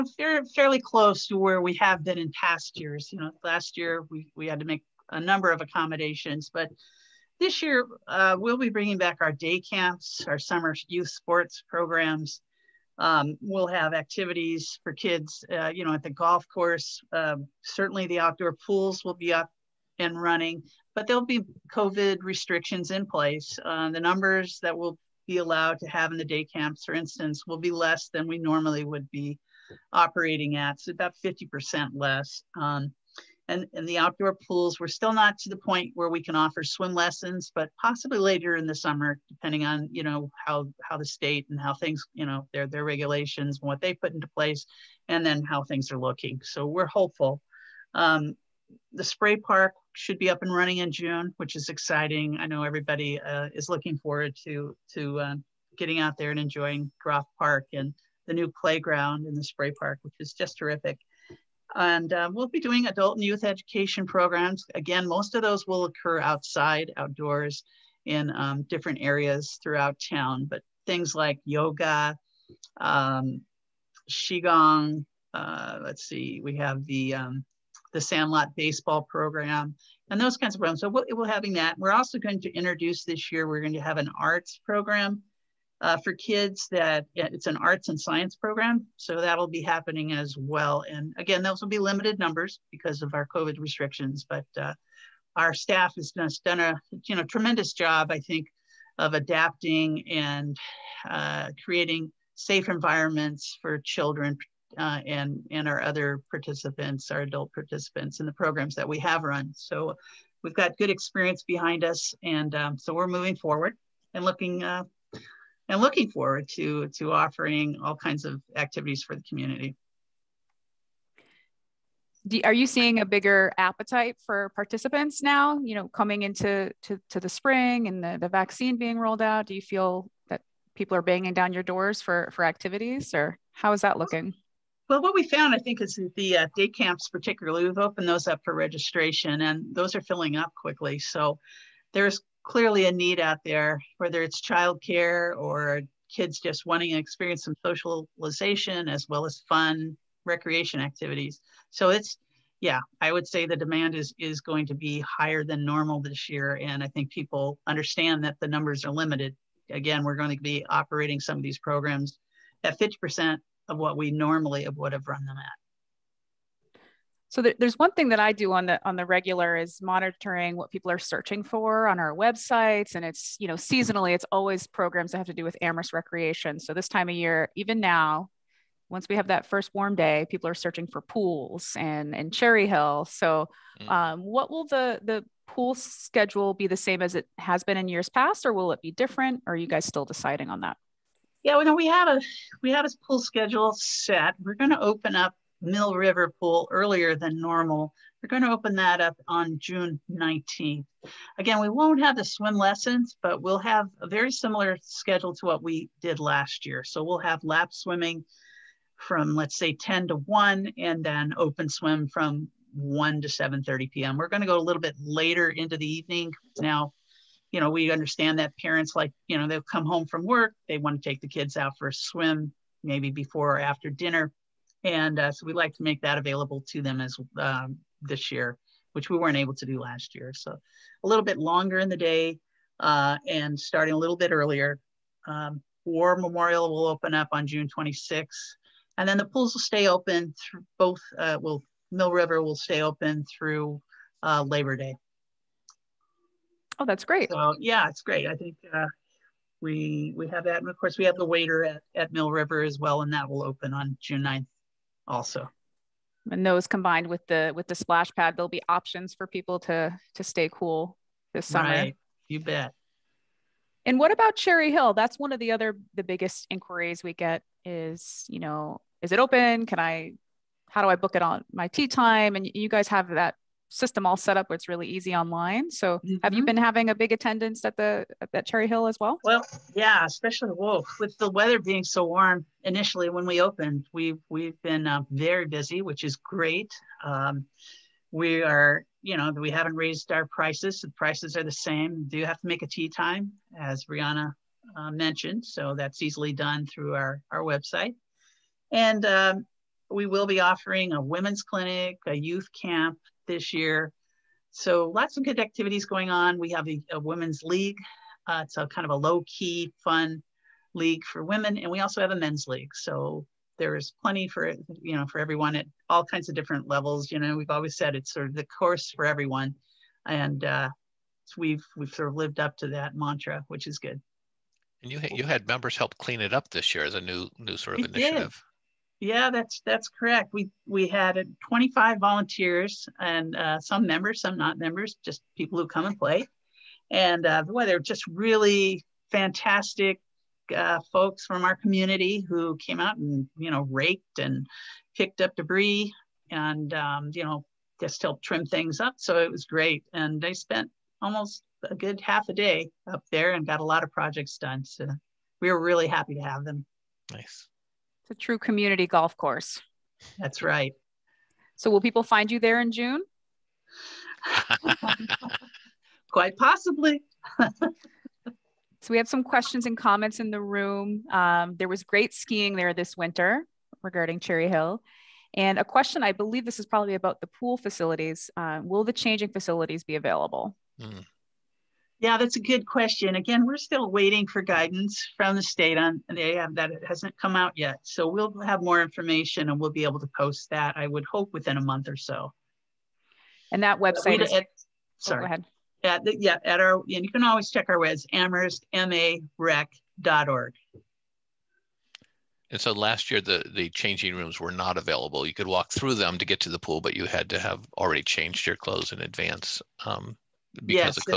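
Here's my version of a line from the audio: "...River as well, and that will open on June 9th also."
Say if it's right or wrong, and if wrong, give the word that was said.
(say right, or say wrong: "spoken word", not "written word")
right.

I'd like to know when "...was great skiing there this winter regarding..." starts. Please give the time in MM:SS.
06:11.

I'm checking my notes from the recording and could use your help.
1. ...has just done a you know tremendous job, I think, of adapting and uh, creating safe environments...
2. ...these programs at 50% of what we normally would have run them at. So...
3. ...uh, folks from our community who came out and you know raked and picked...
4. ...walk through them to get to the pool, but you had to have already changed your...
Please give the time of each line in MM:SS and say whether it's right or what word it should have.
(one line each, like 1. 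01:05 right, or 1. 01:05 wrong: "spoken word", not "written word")
1. 01:35 right
2. 02:41 right
3. 05:40 right
4. 06:45 right.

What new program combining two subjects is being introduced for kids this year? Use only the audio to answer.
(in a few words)
Arts and science program.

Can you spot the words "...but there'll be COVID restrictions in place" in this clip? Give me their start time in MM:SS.
00:20.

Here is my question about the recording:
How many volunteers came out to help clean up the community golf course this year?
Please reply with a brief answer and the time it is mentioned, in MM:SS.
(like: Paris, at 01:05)
25, at 05:31.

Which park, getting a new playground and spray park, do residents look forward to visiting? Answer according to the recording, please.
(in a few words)
Groff Park.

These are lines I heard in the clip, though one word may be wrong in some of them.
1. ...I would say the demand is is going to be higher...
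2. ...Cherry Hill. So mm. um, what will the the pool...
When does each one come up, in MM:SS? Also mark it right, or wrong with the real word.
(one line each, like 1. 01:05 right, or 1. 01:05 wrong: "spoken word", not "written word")
1. 02:33 right
2. 03:02 right.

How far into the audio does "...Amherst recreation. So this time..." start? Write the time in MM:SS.
02:55.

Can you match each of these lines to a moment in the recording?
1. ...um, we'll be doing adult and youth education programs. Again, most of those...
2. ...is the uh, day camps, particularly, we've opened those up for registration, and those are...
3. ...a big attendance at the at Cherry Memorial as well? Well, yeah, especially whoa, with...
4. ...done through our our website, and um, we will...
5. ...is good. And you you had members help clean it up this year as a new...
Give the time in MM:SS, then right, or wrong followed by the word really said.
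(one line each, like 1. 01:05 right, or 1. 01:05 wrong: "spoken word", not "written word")
1. 01:02 right
2. 02:15 right
3. 04:36 wrong: "Hill", not "Memorial"
4. 04:56 right
5. 05:23 right.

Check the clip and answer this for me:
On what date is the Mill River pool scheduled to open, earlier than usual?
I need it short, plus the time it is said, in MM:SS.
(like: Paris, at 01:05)
June 19, at 03:19.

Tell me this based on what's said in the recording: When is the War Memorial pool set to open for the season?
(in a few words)
June 26.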